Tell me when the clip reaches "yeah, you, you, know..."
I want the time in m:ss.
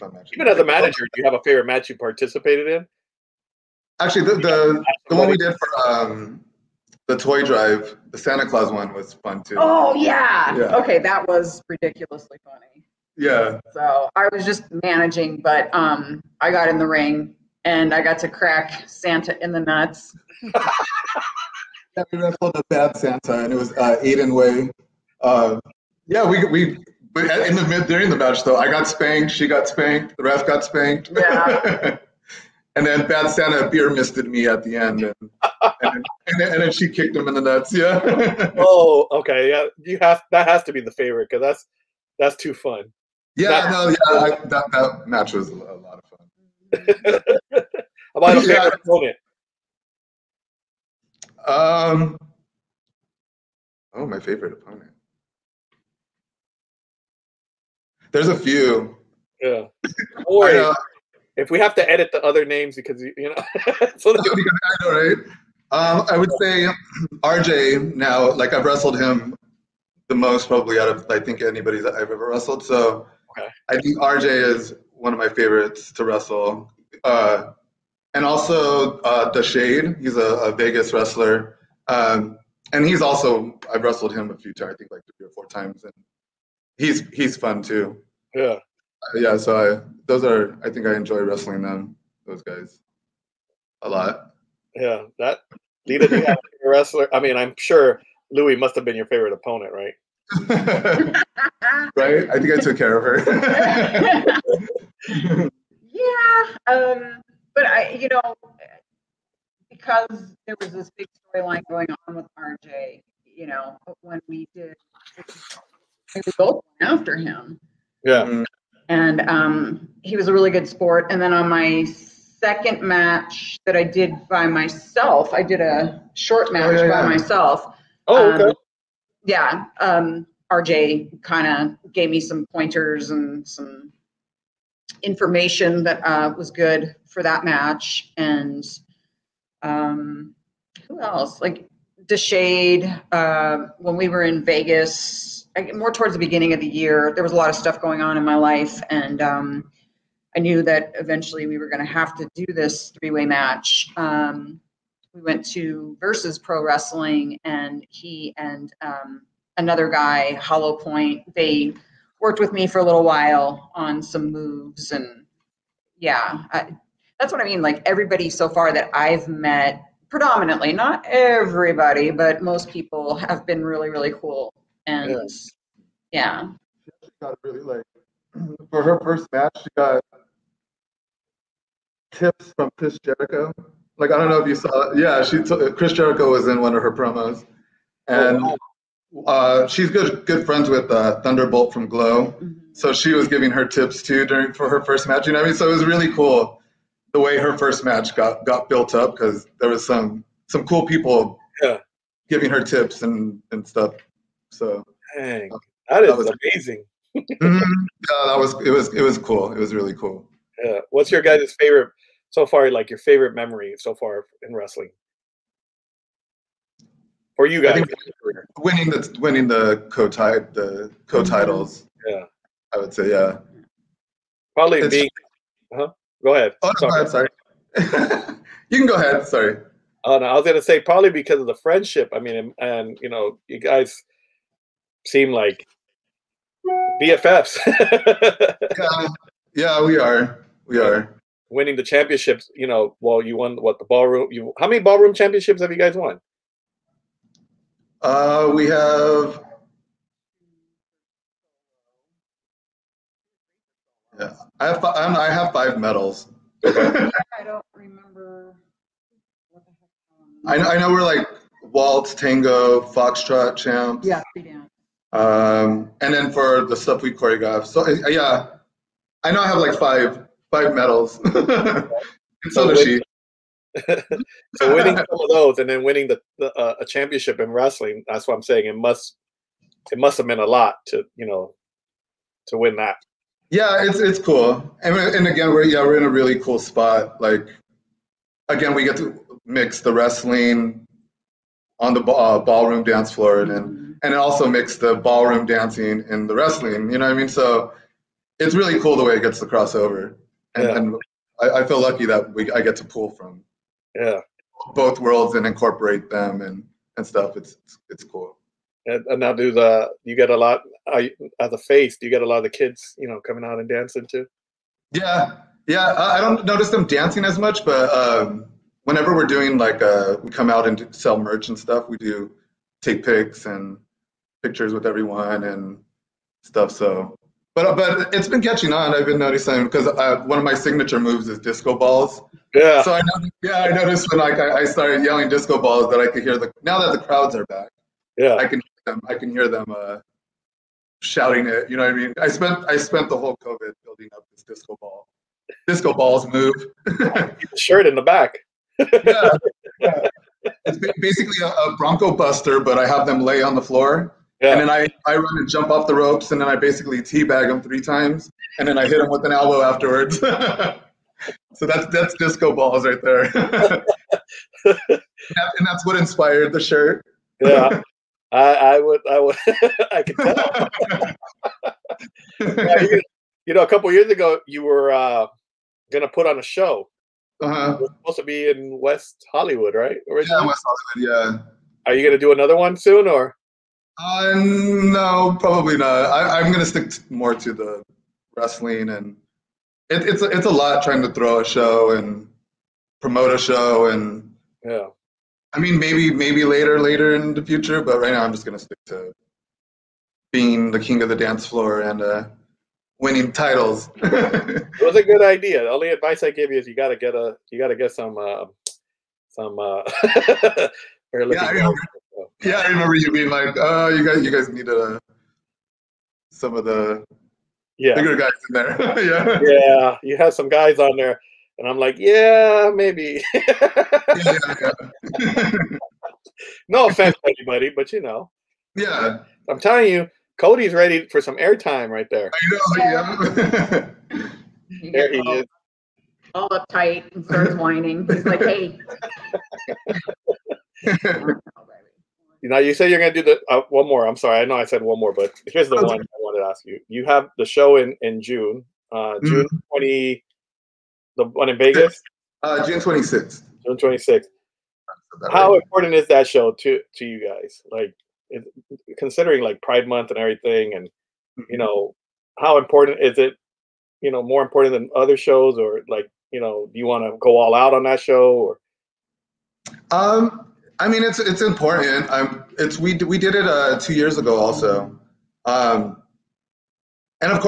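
6:12.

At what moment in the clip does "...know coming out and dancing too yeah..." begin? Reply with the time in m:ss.
5:13.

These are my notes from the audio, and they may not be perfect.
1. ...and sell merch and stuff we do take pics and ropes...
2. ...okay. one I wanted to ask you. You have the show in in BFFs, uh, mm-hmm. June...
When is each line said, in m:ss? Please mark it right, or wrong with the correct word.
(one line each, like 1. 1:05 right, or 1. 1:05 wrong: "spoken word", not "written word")
1. 5:20 wrong: "pictures", not "ropes"
2. 7:25 wrong: "June", not "BFFs".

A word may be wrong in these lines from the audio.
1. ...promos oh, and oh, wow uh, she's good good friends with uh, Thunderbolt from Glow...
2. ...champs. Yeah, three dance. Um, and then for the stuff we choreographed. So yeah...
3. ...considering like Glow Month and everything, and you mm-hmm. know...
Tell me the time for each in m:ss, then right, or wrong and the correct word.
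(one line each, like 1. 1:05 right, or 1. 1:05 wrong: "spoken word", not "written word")
1. 3:06 right
2. 4:23 right
3. 7:38 wrong: "Pride", not "Glow".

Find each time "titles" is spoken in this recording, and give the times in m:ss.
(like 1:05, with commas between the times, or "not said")
3:41, 6:43.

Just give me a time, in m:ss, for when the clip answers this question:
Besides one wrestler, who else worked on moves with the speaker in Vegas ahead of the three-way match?
2:40.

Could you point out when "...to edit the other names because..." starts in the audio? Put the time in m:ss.
1:01.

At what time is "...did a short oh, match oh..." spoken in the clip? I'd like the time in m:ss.
2:05.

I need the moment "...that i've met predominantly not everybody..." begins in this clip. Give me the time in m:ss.
2:48.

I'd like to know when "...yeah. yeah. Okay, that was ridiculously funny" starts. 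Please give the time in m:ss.
0:09.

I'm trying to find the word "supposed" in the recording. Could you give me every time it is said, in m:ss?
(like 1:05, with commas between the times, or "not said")
6:18.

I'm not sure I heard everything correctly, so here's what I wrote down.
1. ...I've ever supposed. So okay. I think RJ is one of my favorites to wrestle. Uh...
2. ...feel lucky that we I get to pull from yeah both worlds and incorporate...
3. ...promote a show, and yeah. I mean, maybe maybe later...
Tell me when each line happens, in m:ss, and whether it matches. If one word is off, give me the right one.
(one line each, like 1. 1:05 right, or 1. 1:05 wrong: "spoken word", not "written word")
1. 1:11 wrong: "wrestled", not "supposed"
2. 5:01 right
3. 6:32 right.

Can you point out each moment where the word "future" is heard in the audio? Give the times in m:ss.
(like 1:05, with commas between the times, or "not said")
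6:37.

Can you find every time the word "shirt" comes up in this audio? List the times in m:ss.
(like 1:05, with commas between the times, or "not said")
5:47, 6:06.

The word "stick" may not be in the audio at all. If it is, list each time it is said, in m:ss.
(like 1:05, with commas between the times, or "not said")
6:26, 6:38.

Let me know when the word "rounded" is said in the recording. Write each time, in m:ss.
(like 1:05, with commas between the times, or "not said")
not said.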